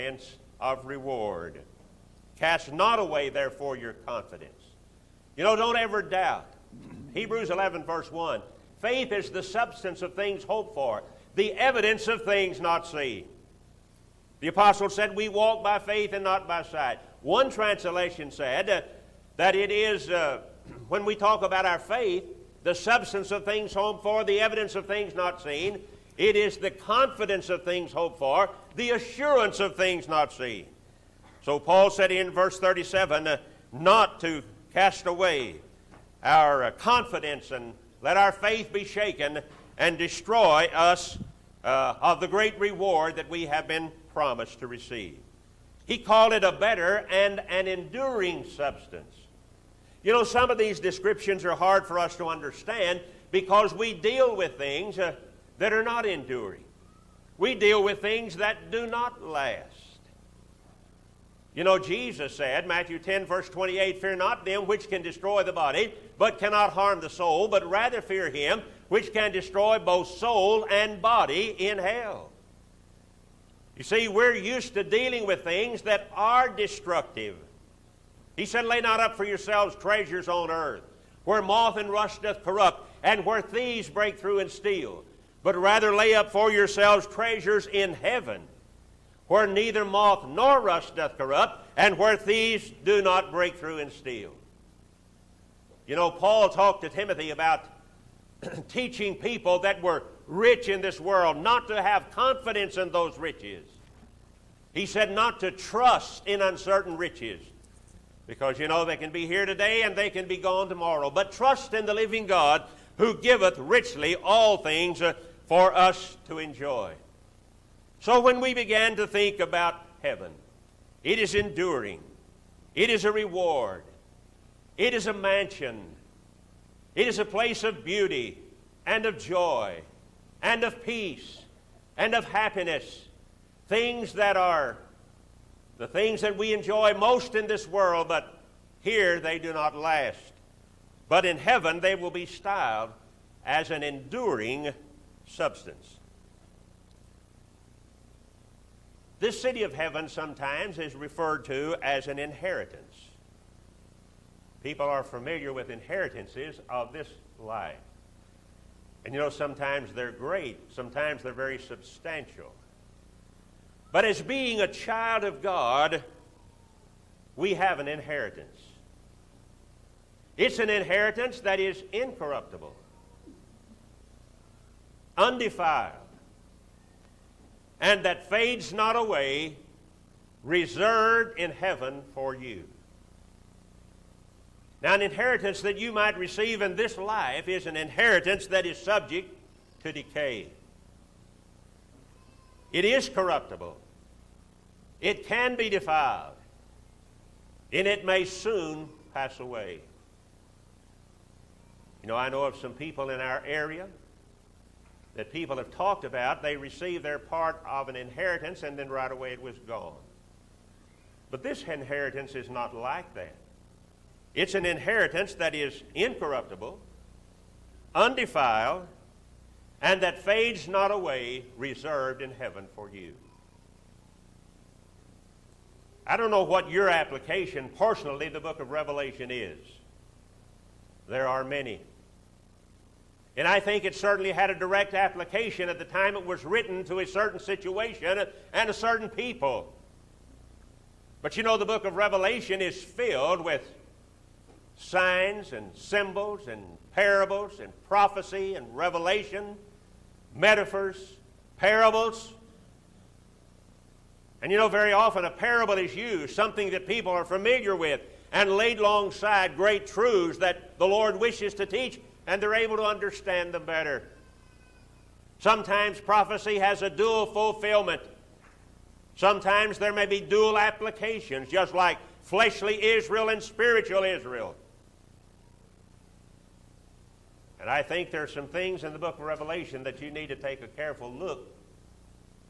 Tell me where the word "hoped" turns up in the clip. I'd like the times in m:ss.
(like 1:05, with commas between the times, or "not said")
0:10, 0:23, 0:27.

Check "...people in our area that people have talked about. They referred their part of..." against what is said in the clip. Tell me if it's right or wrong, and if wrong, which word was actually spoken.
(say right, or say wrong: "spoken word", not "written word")
wrong: "received", not "referred".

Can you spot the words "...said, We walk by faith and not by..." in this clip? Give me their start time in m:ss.
0:14.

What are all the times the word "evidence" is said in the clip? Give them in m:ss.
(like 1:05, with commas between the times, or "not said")
0:11, 0:24.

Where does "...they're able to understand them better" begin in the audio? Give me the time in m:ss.
4:22.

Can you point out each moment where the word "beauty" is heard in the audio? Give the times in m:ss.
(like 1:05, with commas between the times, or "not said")
2:07.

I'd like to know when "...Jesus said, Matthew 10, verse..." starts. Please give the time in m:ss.
1:01.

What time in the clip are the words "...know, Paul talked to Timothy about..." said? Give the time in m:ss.
1:35.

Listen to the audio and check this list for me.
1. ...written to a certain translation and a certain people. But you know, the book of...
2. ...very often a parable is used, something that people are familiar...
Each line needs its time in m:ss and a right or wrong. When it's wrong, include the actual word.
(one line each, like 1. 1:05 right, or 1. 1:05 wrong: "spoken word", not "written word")
1. 3:56 wrong: "situation", not "translation"
2. 4:14 right.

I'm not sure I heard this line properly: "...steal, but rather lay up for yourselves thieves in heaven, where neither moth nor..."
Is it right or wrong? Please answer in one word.
wrong.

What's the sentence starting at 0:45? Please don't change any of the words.
He called it a better and an enduring substance.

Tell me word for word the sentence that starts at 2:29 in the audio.
This city of heaven sometimes is referred to as an inheritance.